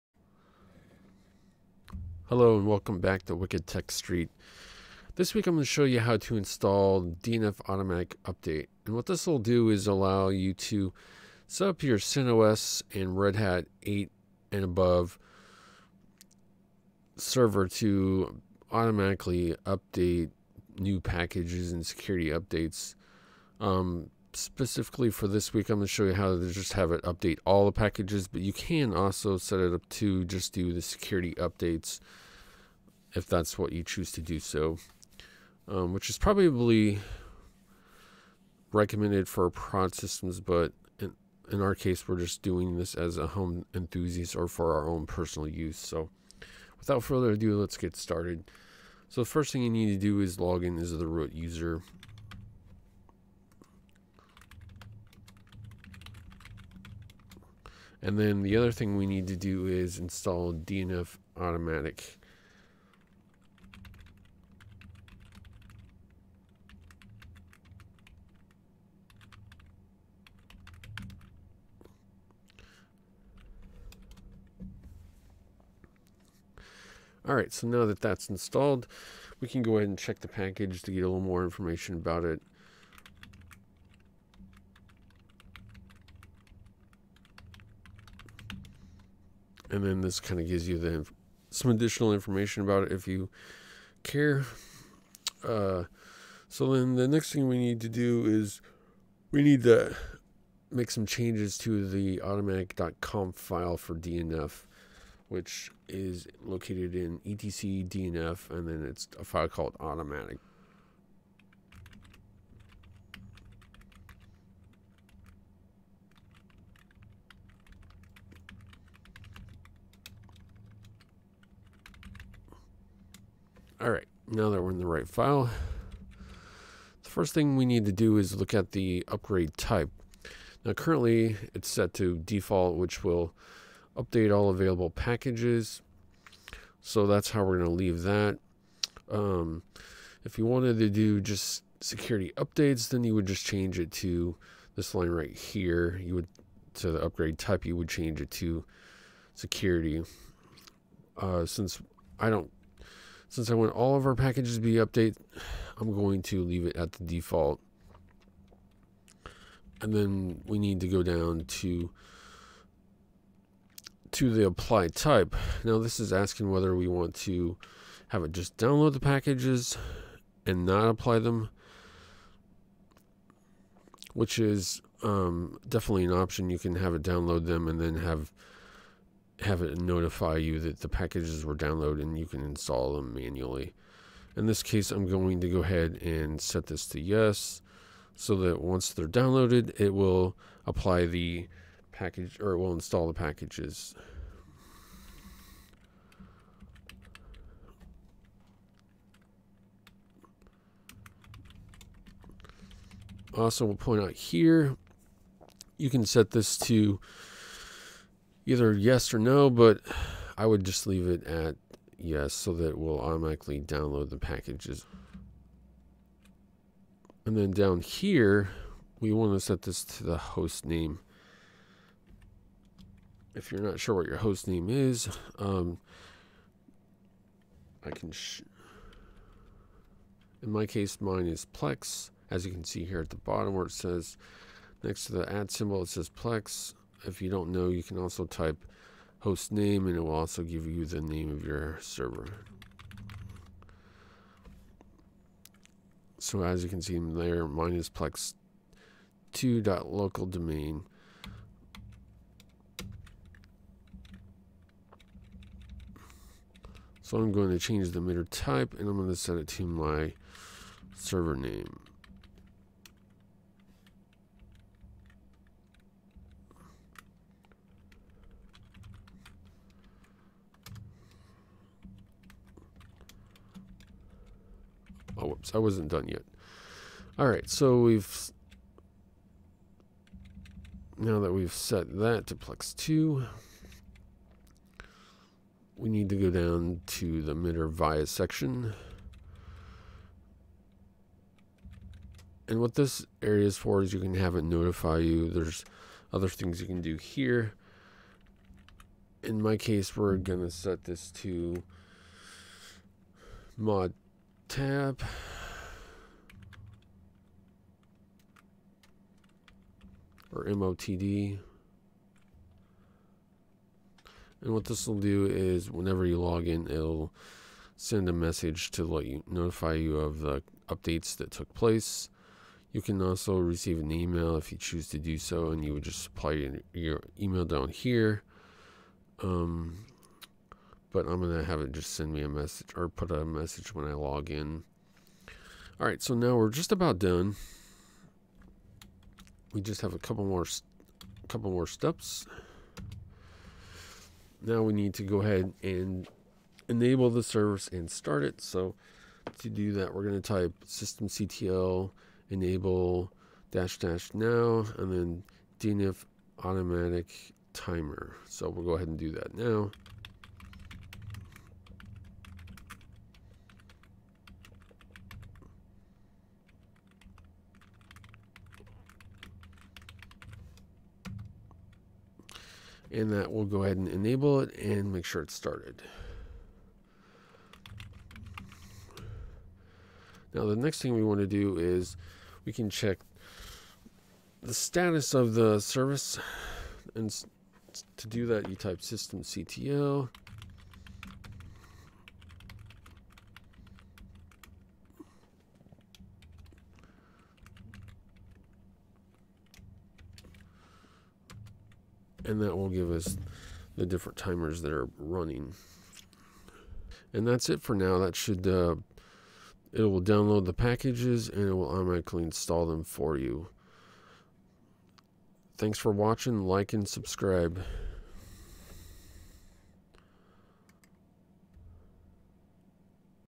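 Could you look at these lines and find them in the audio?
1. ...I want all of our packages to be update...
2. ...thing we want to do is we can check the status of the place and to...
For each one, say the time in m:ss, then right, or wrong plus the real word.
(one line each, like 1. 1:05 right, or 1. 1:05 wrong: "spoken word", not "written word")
1. 2:33 right
2. 6:20 wrong: "service", not "place".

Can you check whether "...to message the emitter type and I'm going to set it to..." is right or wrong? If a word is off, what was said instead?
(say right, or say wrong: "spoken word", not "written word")
wrong: "change", not "message".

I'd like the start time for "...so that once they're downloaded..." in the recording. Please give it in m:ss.
3:08.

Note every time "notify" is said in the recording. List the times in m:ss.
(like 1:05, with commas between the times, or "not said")
2:59, 4:54, 5:19.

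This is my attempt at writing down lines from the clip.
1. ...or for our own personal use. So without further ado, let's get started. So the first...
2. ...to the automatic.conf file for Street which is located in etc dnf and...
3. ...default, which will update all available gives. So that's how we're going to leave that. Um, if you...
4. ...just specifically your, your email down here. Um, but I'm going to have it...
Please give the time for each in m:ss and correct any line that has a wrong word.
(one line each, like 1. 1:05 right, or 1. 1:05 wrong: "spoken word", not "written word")
1. 0:44 right
2. 1:41 wrong: "DNF", not "Street"
3. 2:12 wrong: "packages", not "gives"
4. 5:25 wrong: "supply", not "specifically".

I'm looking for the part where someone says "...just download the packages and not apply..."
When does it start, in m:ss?
2:48.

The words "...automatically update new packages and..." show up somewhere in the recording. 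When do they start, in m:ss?
0:18.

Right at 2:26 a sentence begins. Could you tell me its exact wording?
You would to the upgrade type, you would change it to security.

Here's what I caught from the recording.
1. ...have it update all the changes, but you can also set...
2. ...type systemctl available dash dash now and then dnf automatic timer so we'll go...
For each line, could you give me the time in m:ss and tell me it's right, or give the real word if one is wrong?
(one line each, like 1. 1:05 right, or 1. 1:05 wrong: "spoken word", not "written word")
1. 0:26 wrong: "packages", not "changes"
2. 5:50 wrong: "enable", not "available".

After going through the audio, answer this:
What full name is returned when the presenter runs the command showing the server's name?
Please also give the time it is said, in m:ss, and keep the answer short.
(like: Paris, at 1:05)
plex 2.local domain, at 4:07.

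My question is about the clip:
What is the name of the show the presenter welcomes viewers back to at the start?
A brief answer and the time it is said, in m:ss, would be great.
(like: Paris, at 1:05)
Wicked Tech Street, at 0:03.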